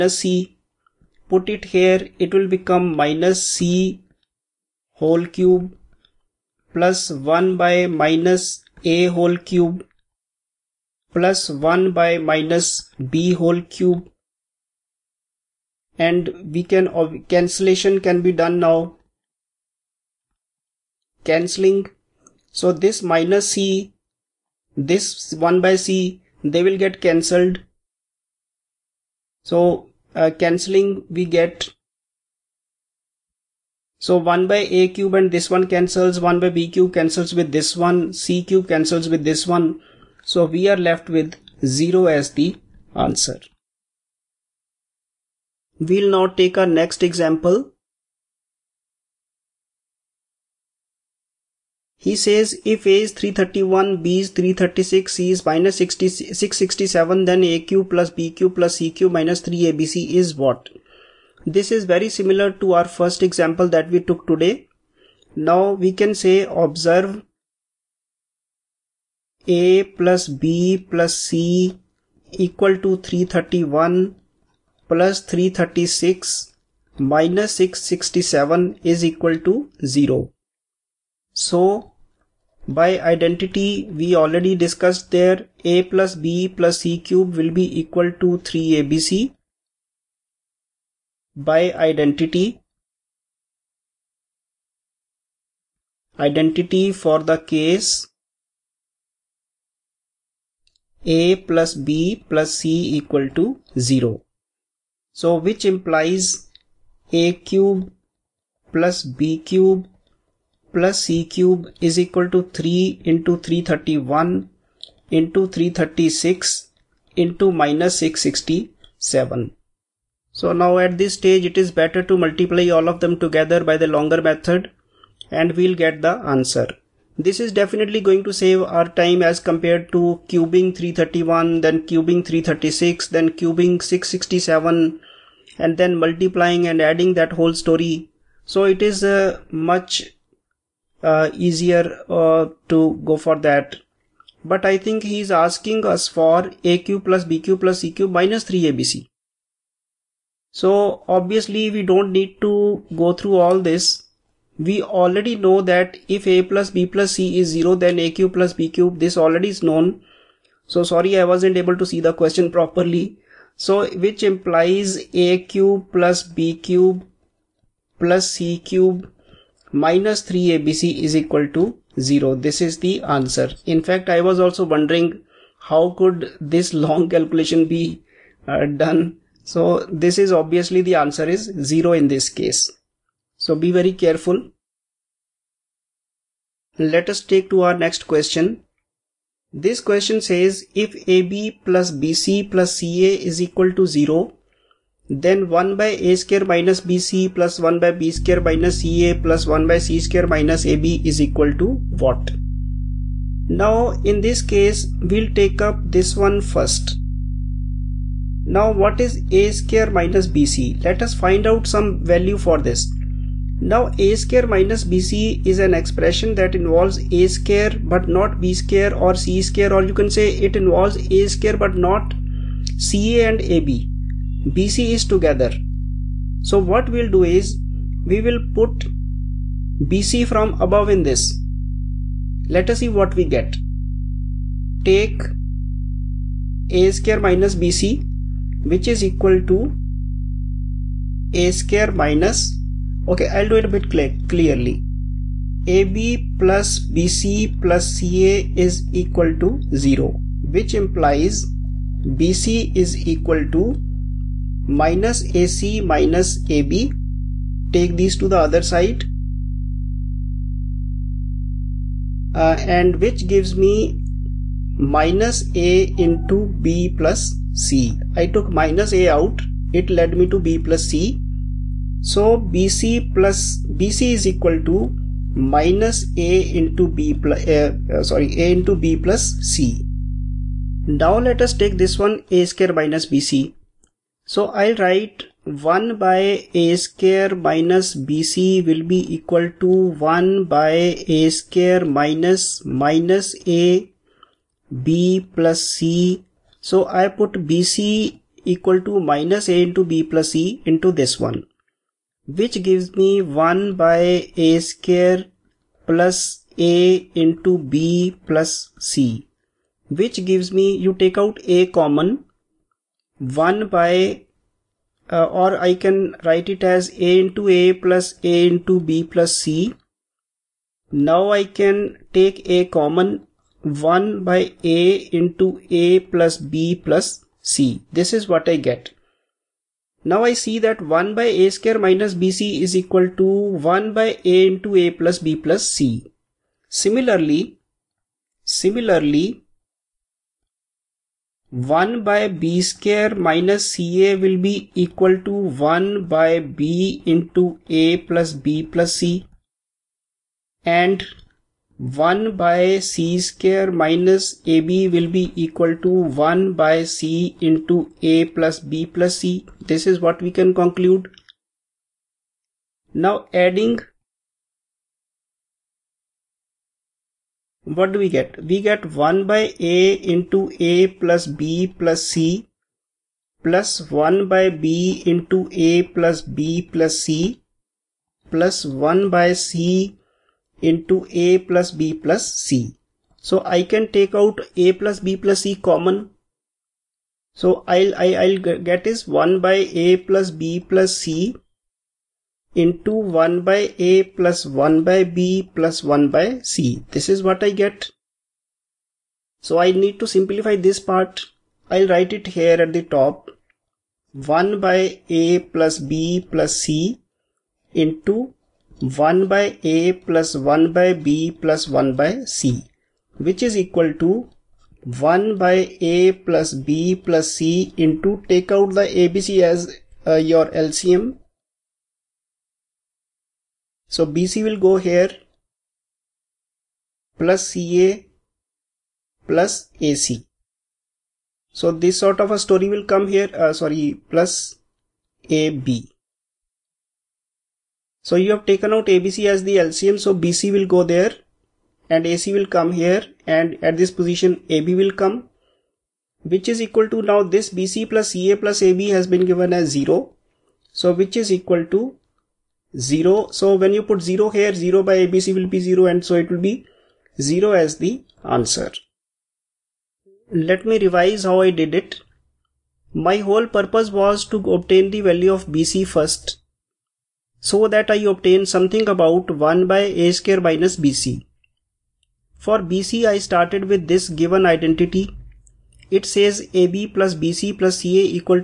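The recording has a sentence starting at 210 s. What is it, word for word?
Let us find out some value for this.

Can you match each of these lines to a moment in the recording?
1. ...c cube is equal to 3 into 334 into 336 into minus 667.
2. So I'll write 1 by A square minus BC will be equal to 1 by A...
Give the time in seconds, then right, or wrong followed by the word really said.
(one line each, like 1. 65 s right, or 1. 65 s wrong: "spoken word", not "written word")
1. 111 s wrong: "331", not "334"
2. 284 s right.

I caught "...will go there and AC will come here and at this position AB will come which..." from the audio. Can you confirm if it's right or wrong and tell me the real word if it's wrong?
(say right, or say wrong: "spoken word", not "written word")
right.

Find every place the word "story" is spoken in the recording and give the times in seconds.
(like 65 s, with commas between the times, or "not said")
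137 s, 432 s.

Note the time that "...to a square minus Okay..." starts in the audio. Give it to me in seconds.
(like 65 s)
239 s.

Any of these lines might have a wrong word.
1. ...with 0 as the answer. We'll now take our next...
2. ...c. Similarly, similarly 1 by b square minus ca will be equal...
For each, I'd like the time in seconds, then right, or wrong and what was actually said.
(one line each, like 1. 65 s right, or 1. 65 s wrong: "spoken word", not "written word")
1. 41 s right
2. 335 s right.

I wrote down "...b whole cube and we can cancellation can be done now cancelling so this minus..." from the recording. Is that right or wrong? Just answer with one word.
right.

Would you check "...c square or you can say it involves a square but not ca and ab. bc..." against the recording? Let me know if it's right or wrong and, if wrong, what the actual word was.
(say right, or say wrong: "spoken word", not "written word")
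right.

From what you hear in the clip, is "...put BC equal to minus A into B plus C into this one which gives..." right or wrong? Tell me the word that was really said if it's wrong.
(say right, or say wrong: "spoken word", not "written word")
right.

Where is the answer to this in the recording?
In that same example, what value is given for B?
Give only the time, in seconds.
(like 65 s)
54 s.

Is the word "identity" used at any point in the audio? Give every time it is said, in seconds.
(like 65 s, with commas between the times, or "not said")
82 s, 91 s, 96 s, 474 s.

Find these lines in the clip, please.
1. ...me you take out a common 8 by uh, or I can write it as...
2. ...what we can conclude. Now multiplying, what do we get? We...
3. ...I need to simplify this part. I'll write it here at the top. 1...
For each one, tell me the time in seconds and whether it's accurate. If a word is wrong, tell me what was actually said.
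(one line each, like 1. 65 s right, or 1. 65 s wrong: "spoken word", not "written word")
1. 310 s wrong: "1", not "8"
2. 359 s wrong: "adding", not "multiplying"
3. 399 s right.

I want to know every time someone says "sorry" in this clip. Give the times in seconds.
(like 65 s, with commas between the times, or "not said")
160 s, 278 s, 433 s.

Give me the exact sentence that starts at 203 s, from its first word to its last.
Now in this case, we'll take up this one first.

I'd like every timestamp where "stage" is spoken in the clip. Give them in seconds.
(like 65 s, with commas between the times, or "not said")
121 s.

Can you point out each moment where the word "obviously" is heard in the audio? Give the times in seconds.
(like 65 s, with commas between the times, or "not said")
151 s, 180 s.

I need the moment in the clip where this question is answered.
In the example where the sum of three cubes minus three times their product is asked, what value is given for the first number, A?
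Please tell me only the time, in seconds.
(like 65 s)
52 s.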